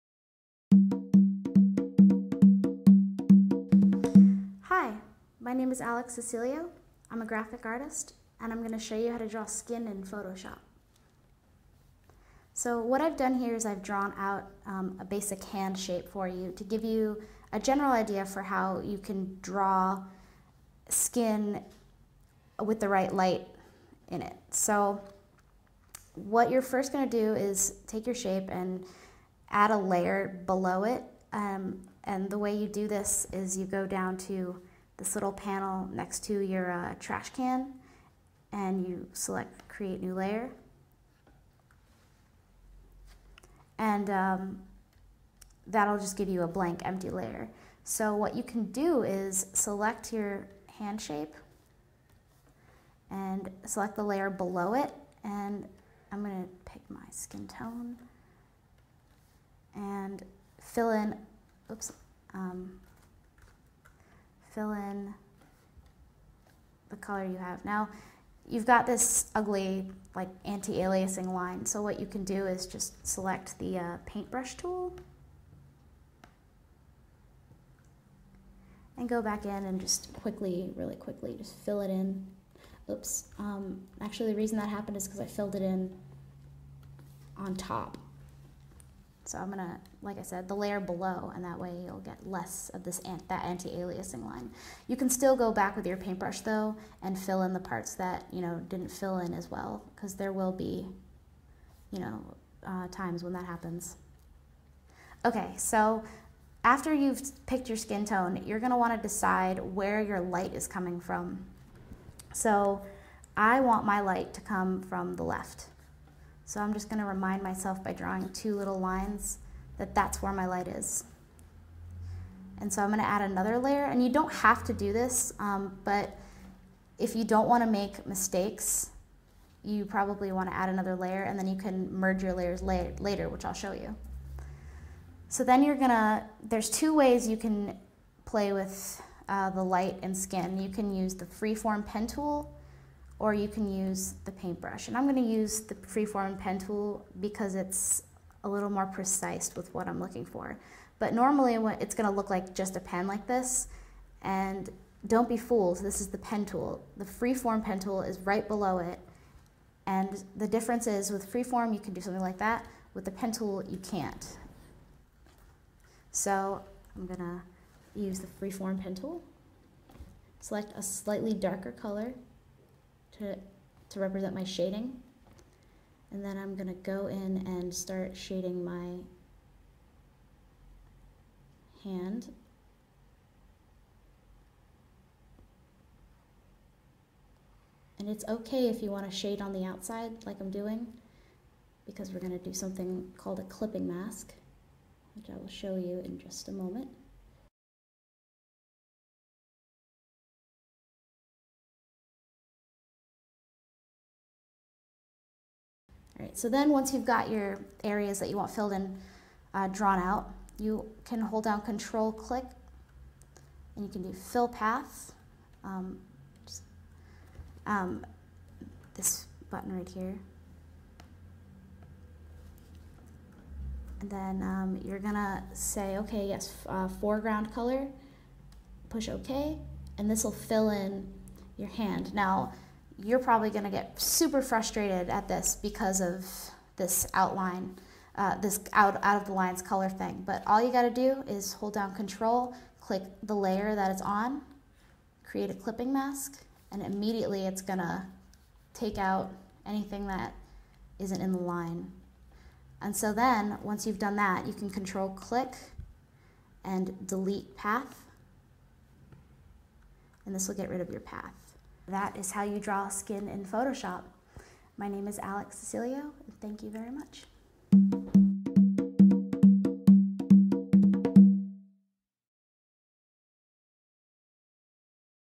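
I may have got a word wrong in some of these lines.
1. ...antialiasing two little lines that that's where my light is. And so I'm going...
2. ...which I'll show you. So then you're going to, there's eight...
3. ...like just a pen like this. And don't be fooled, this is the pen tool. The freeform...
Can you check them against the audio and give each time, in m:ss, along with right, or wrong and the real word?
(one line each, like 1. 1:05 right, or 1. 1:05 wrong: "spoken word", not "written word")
1. 1:57 wrong: "drawing", not "antialiasing"
2. 2:13 wrong: "two", not "eight"
3. 2:32 right.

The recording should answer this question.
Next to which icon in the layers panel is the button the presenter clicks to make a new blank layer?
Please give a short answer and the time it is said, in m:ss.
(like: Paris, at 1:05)
Trash can, at 0:36.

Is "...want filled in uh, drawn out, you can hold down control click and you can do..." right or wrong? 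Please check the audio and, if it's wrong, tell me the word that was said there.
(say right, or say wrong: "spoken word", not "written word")
right.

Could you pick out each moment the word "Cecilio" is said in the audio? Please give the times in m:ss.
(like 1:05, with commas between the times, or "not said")
0:06, 4:25.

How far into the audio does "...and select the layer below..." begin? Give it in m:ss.
0:53.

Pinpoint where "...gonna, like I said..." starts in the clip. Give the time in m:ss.
1:29.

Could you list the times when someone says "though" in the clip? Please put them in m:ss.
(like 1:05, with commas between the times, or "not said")
1:36.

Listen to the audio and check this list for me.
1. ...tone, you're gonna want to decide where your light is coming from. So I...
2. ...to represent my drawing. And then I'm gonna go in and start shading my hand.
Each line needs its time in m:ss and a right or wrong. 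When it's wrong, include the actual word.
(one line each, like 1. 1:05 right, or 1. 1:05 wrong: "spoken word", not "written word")
1. 1:48 right
2. 2:53 wrong: "shading", not "drawing".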